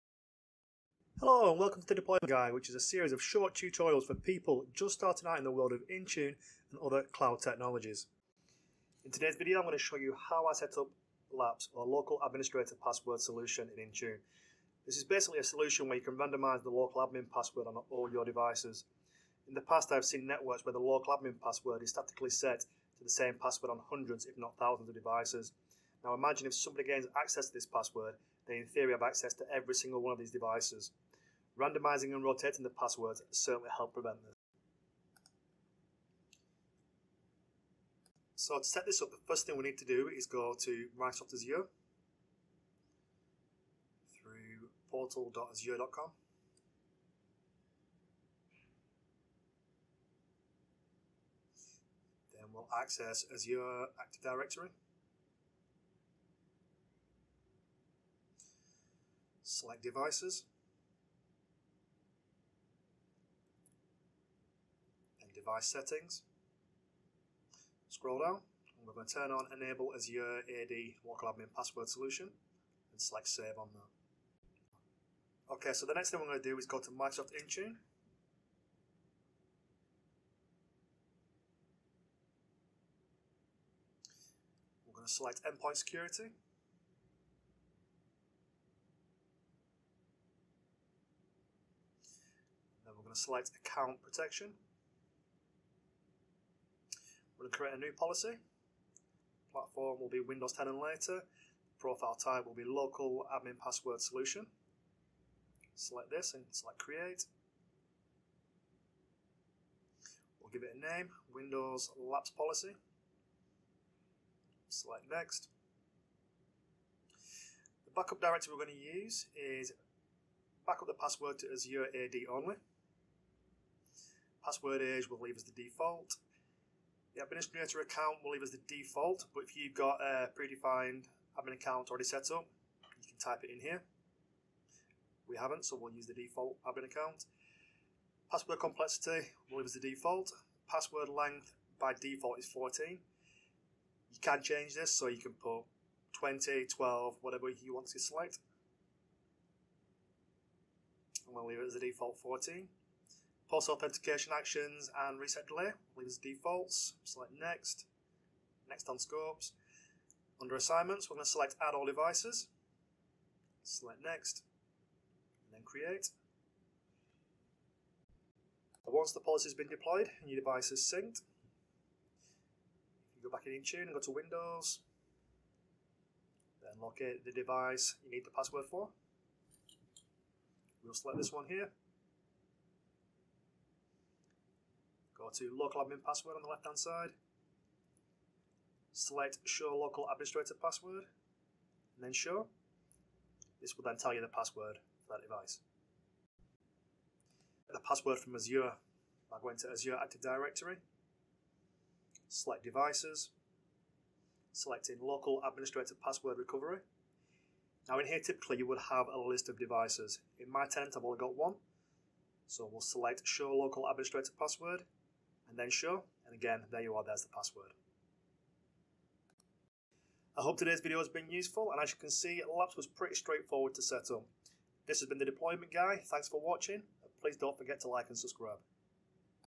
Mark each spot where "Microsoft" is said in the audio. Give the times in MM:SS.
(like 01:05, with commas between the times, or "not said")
00:40, 01:16.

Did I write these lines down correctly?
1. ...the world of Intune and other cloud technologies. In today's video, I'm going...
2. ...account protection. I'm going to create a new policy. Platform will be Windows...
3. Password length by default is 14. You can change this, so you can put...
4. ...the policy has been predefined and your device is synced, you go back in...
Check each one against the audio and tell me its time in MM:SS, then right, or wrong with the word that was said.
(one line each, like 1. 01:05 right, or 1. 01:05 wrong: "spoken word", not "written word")
1. 00:05 right
2. 01:33 right
3. 02:20 right
4. 02:49 wrong: "deployed", not "predefined".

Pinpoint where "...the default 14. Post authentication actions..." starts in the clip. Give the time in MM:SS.
02:31.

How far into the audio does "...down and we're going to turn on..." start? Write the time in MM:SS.
01:08.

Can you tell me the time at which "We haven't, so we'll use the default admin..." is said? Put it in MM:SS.
02:15.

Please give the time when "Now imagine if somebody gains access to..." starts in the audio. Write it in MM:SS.
00:26.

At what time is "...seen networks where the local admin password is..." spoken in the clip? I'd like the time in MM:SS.
00:20.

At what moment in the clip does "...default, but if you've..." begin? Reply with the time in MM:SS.
02:08.